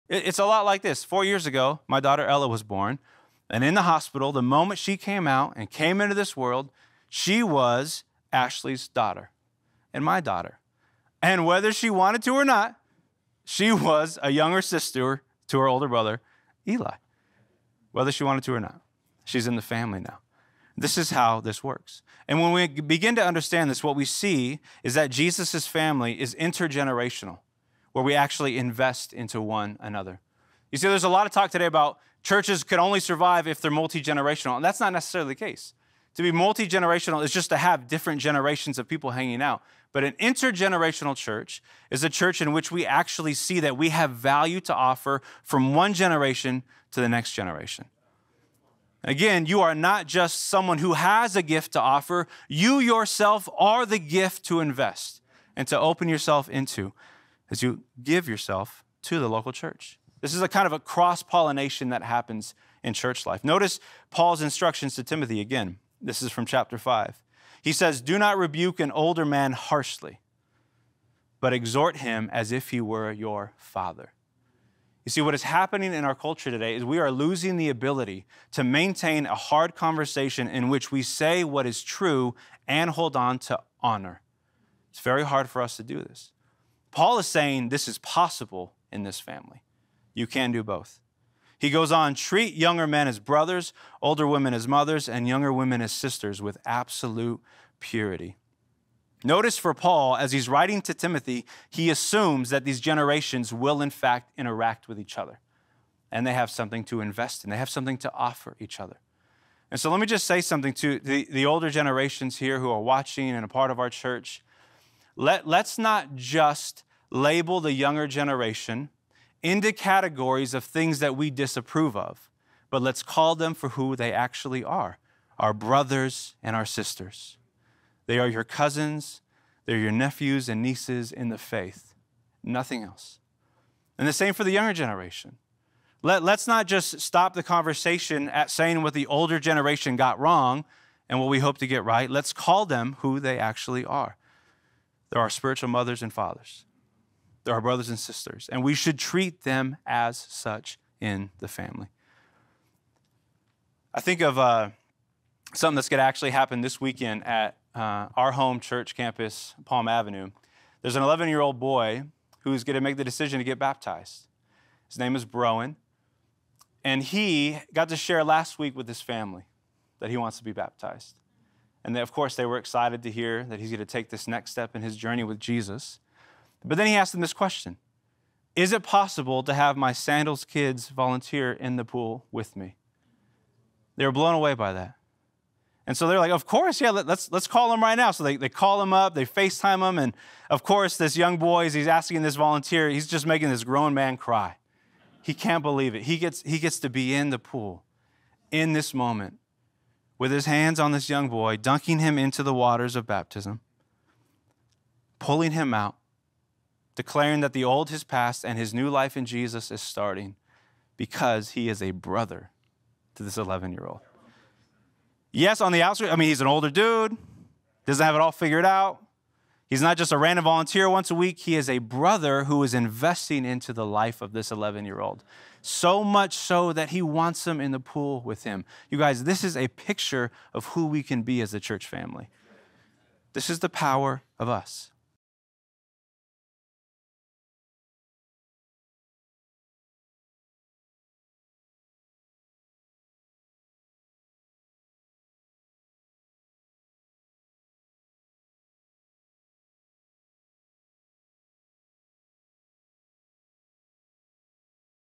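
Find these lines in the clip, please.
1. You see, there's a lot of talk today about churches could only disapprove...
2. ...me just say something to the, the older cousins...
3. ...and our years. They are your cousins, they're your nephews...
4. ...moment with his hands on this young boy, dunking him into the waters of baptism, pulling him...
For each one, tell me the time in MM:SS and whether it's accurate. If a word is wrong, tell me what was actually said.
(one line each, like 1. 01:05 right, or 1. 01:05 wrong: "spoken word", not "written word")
1. 00:30 wrong: "survive", not "disapprove"
2. 01:50 wrong: "generations", not "cousins"
3. 02:06 wrong: "sisters", not "years"
4. 03:18 right.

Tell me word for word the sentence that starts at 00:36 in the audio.
To be multi generational is just to have different generations of people hanging out.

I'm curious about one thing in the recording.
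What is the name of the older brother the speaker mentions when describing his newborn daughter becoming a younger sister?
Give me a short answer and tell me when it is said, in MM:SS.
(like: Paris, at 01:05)
Eli, at 00:16.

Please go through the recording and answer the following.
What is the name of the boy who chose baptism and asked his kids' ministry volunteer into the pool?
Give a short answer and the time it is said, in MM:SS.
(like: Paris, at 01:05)
Broen, at 02:45.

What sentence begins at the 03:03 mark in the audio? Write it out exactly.
They were blown away by that.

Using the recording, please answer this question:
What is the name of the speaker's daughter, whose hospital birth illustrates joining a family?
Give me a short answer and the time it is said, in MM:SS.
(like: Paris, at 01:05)
Ella, at 00:02.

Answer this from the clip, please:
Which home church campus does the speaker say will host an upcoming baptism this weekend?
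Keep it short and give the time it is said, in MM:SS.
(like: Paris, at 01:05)
Palm Avenue, at 02:39.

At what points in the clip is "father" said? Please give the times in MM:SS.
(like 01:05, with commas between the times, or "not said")
01:13, 02:26.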